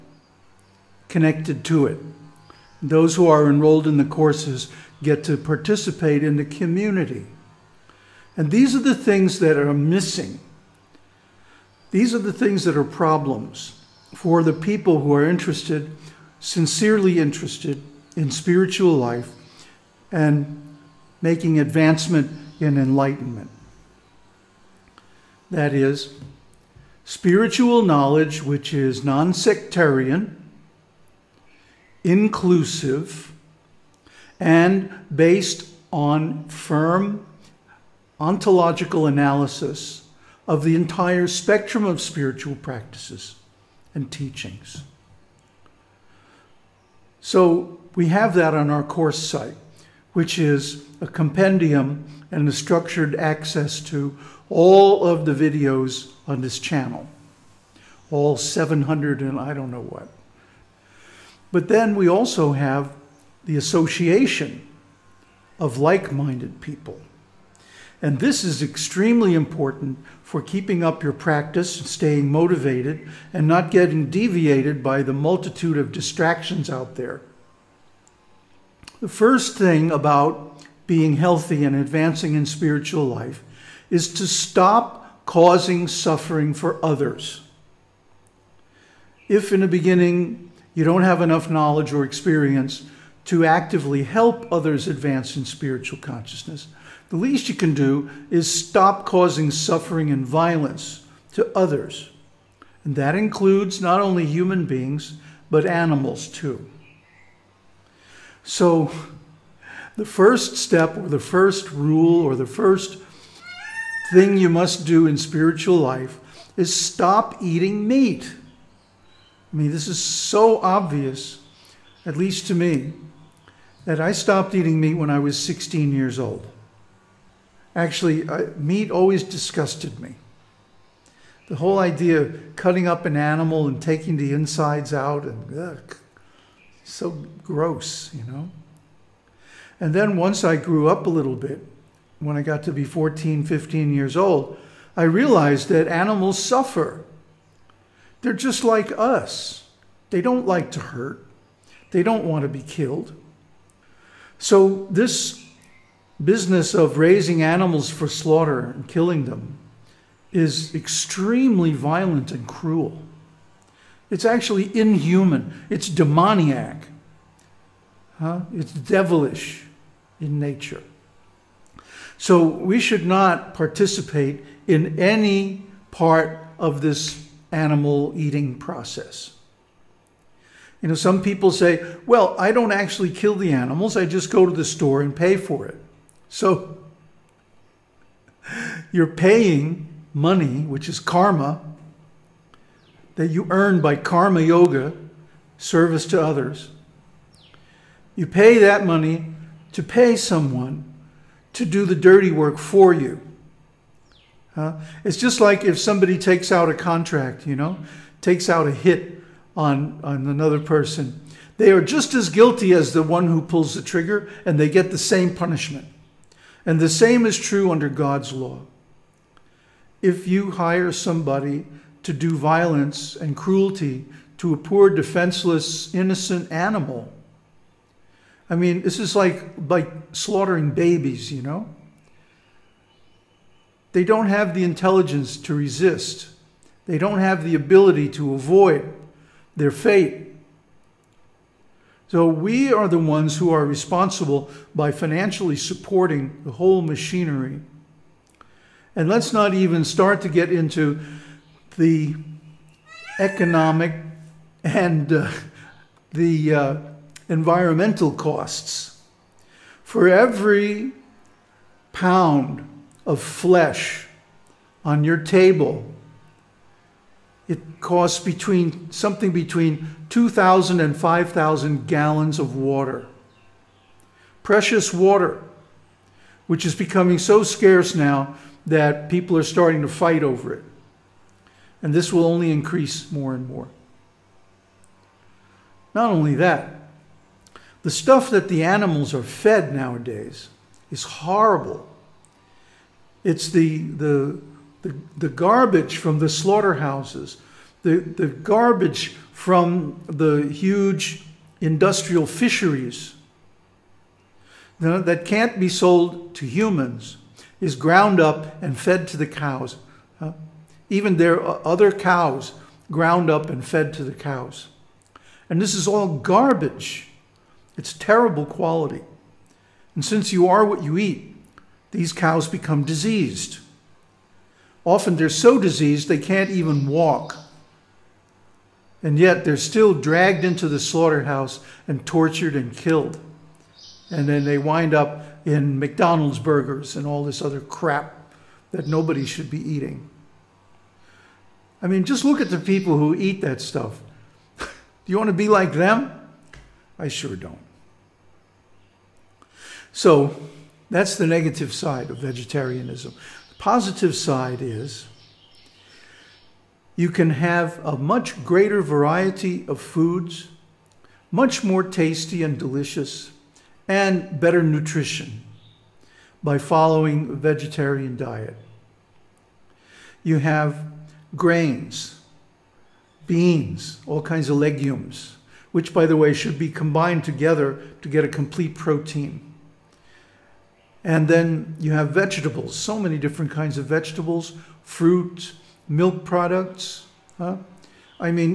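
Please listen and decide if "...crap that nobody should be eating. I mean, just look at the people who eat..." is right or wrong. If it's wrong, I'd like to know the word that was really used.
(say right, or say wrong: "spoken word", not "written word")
right.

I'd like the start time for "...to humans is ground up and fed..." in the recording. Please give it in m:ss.
5:06.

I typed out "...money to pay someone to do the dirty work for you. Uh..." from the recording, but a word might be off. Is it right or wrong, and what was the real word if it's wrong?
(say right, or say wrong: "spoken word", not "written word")
right.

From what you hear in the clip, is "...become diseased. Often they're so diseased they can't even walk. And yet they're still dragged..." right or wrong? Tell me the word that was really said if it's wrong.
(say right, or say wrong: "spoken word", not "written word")
right.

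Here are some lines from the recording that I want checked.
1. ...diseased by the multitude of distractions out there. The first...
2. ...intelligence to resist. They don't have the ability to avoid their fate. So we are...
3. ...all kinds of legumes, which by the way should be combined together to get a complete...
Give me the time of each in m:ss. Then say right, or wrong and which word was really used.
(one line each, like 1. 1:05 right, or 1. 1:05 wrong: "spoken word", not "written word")
1. 1:14 wrong: "deviated", not "diseased"
2. 3:54 right
3. 6:14 right.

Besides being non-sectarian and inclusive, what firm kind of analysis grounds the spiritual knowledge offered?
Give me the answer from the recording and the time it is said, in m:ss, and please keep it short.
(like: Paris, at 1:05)
Ontological analysis, at 0:38.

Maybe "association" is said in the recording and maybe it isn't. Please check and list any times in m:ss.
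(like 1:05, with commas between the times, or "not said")
1:03.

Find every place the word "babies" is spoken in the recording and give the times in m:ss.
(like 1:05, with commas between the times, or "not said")
3:50.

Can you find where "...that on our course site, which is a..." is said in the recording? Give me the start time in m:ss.
0:48.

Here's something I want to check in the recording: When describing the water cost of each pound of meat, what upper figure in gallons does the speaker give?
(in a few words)
5,000 gallons.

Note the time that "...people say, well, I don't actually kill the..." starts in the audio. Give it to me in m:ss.
3:01.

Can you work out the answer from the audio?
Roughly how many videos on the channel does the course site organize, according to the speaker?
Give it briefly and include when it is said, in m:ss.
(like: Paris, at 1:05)
700, at 0:58.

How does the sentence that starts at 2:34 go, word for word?
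So this business of raising animals for slaughter and killing them is extremely violent and cruel.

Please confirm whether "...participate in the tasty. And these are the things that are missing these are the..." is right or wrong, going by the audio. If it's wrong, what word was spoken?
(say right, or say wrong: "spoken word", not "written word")
wrong: "community", not "tasty".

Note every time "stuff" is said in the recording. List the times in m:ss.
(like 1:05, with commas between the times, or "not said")
4:47, 5:43.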